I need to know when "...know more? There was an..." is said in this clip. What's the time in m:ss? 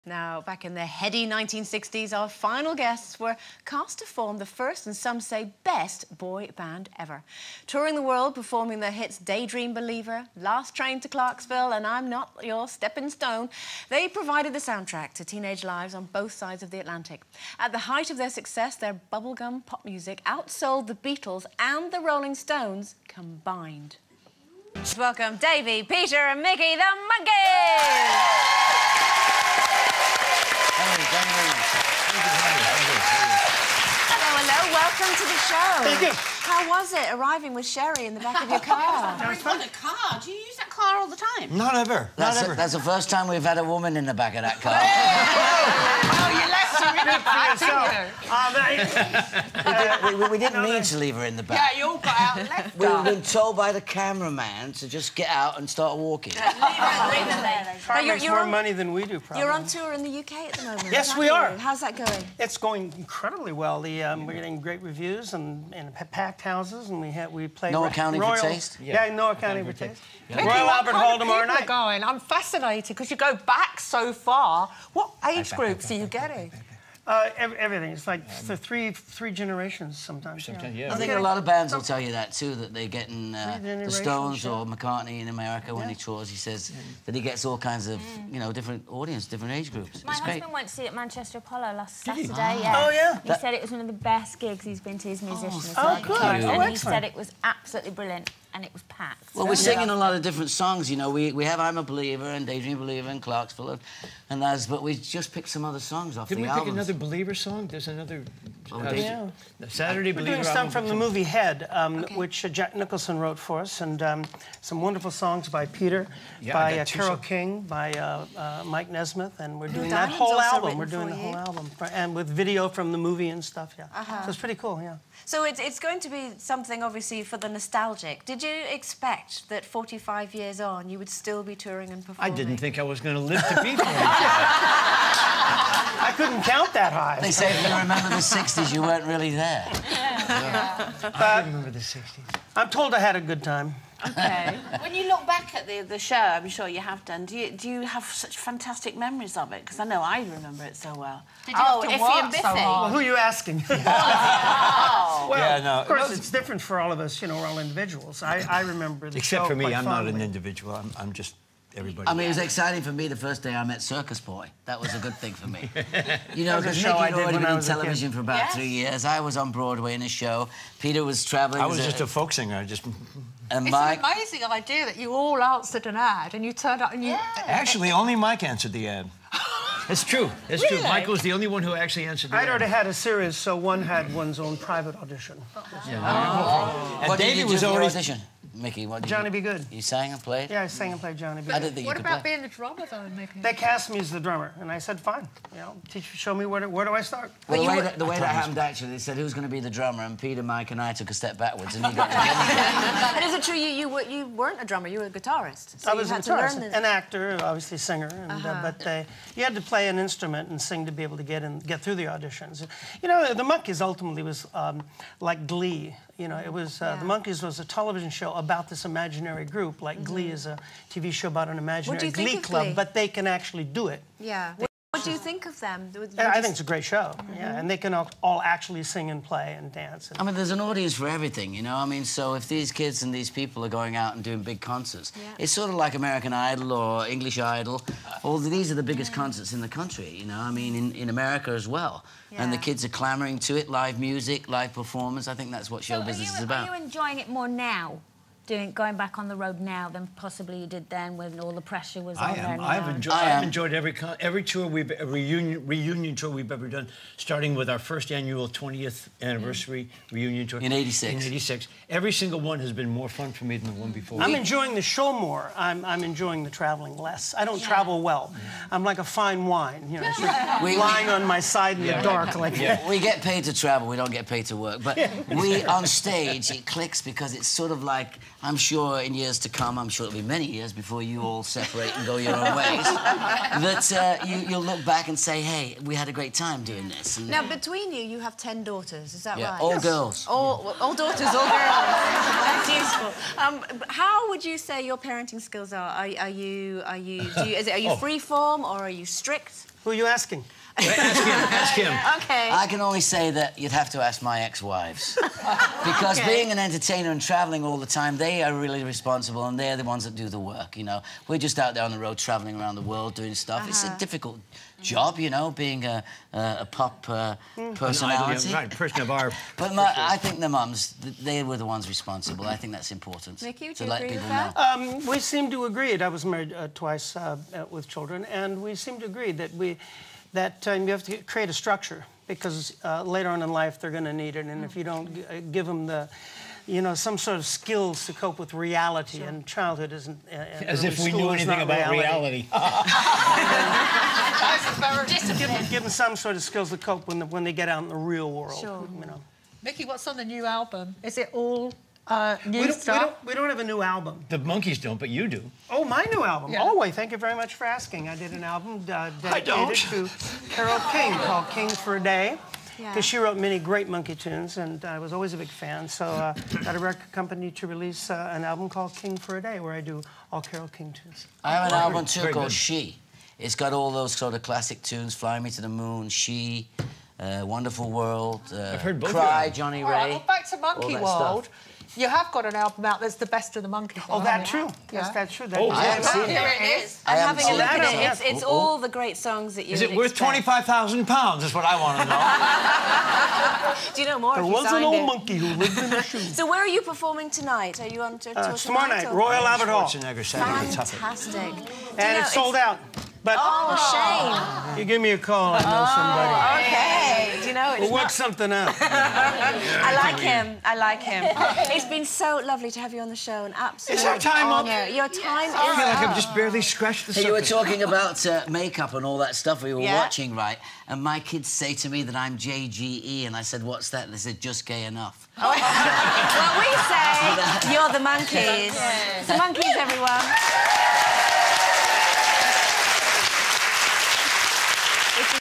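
6:34.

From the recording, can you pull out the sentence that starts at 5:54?
The Monkees don't, but you do.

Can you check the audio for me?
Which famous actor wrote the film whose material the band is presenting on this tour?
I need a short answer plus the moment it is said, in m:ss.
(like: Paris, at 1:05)
Jack Nicholson, at 1:52.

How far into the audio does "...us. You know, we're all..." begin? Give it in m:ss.
2:36.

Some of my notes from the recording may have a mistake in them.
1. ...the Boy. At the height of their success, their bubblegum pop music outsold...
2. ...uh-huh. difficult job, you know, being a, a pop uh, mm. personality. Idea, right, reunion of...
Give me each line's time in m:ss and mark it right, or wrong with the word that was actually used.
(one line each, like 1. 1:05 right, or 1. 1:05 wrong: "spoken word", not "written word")
1. 0:16 wrong: "Atlantic", not "Boy"
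2. 5:13 wrong: "person", not "reunion".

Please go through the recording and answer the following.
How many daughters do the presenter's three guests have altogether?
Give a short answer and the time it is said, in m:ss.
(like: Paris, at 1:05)
10, at 4:48.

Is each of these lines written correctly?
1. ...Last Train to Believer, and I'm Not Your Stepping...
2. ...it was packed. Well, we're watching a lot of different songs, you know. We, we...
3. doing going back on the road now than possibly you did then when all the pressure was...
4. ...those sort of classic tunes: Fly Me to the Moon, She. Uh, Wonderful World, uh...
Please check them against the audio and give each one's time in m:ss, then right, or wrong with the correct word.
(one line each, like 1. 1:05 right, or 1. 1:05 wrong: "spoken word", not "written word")
1. 0:10 wrong: "Clarksville", not "Believer"
2. 1:38 wrong: "singing", not "watching"
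3. 4:08 right
4. 6:13 right.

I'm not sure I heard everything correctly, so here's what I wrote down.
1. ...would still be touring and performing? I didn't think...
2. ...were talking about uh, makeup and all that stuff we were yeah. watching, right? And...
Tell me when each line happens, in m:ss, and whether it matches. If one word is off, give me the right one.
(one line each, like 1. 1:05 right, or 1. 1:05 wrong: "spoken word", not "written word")
1. 2:10 right
2. 6:57 right.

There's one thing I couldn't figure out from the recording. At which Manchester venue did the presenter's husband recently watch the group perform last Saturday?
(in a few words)
Manchester Apollo.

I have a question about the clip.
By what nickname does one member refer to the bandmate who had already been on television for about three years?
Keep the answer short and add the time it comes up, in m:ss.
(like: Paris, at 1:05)
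Circus Boy, at 2:43.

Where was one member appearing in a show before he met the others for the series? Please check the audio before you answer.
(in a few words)
Broadway.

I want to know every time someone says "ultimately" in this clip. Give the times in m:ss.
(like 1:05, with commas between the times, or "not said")
3:33.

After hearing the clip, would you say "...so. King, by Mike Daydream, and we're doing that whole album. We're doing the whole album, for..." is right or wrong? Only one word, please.
wrong.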